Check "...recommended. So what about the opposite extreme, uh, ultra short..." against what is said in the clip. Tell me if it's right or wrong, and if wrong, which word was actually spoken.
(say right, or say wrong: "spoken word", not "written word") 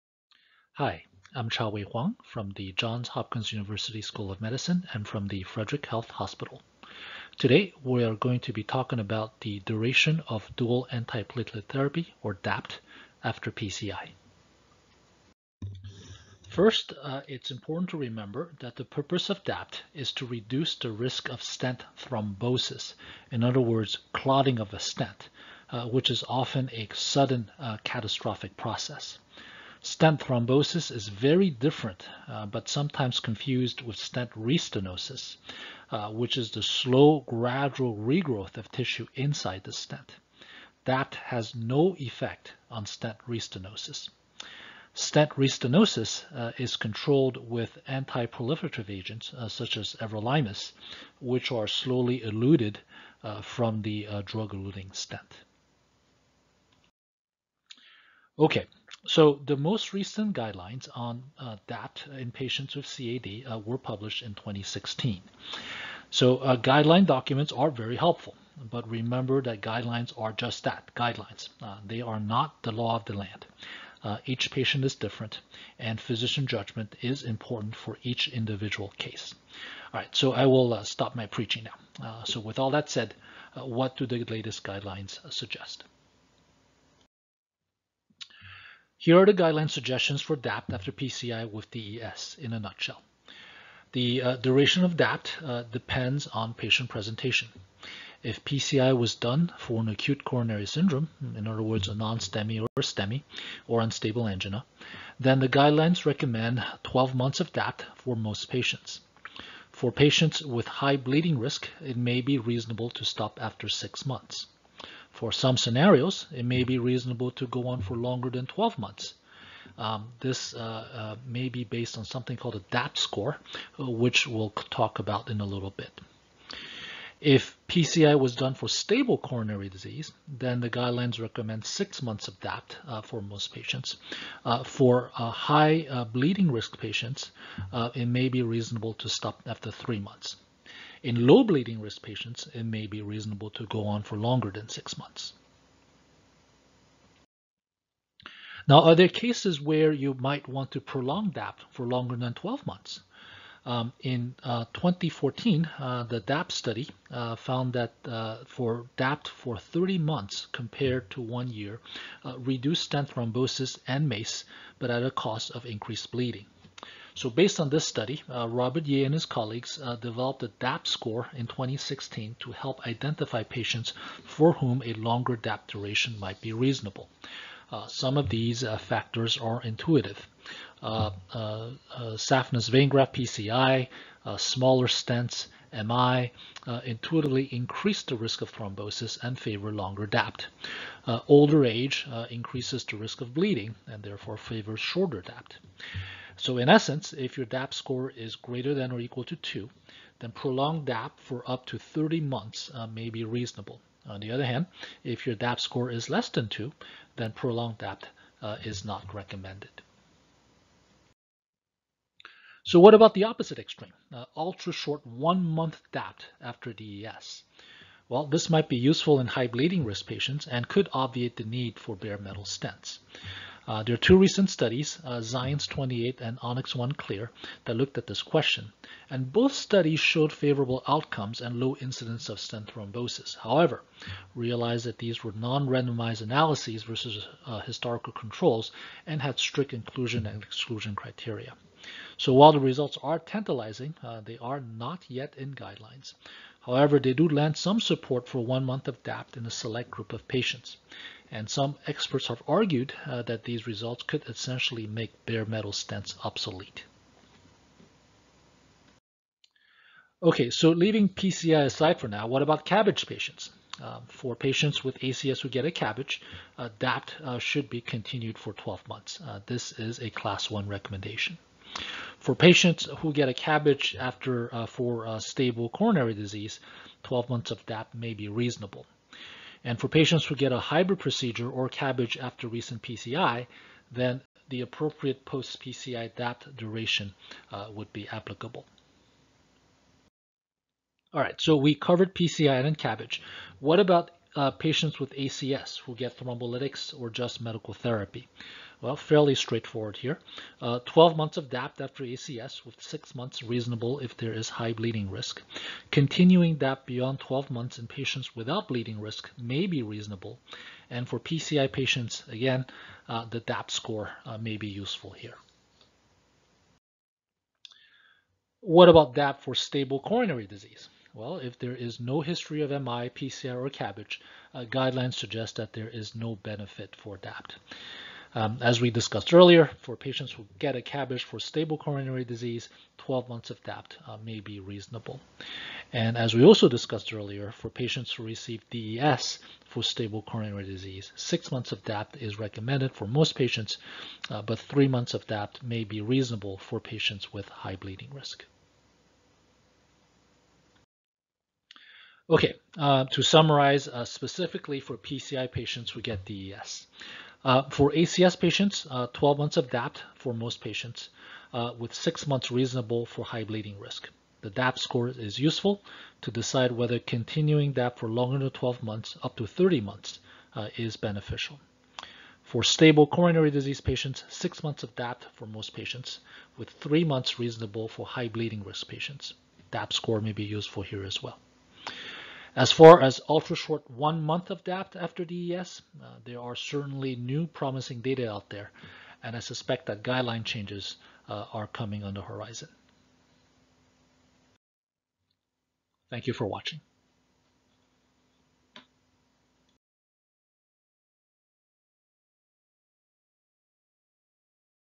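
right.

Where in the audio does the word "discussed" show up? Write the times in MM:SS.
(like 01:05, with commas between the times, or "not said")
05:28, 05:36.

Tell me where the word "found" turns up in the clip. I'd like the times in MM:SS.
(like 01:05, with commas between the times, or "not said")
02:37.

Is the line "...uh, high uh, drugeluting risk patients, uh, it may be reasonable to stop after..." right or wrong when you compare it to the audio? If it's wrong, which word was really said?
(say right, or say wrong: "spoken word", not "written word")
wrong: "bleeding", not "drugeluting".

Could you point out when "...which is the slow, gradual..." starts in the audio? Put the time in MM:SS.
00:36.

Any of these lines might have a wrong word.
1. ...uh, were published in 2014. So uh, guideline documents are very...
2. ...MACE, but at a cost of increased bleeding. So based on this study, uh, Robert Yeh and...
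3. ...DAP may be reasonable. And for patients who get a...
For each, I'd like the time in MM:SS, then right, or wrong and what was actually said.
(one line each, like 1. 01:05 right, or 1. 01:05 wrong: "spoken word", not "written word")
1. 01:03 wrong: "2016", not "2014"
2. 02:44 right
3. 04:37 right.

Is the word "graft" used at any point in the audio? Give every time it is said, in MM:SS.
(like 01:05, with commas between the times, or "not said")
03:02.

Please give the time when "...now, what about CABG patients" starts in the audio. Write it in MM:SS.
04:22.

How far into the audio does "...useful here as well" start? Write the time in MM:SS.
06:20.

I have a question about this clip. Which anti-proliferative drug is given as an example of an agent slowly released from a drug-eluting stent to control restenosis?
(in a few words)
everolimus.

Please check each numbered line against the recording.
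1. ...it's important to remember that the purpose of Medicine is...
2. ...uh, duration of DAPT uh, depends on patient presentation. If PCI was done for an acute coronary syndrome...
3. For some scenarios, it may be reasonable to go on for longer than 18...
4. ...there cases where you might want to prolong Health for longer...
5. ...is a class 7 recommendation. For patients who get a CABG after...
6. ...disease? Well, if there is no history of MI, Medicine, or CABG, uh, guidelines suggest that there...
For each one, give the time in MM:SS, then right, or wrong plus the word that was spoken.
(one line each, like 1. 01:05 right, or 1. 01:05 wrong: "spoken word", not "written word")
1. 00:17 wrong: "DAPT", not "Medicine"
2. 01:34 right
3. 01:55 wrong: "12", not "18"
4. 02:28 wrong: "DAP", not "Health"
5. 04:29 wrong: "1", not "7"
6. 05:20 wrong: "PCI", not "Medicine".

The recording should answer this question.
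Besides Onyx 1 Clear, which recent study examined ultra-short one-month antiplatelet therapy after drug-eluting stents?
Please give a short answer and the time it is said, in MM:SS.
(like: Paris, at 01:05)
XIENCE 28, at 03:45.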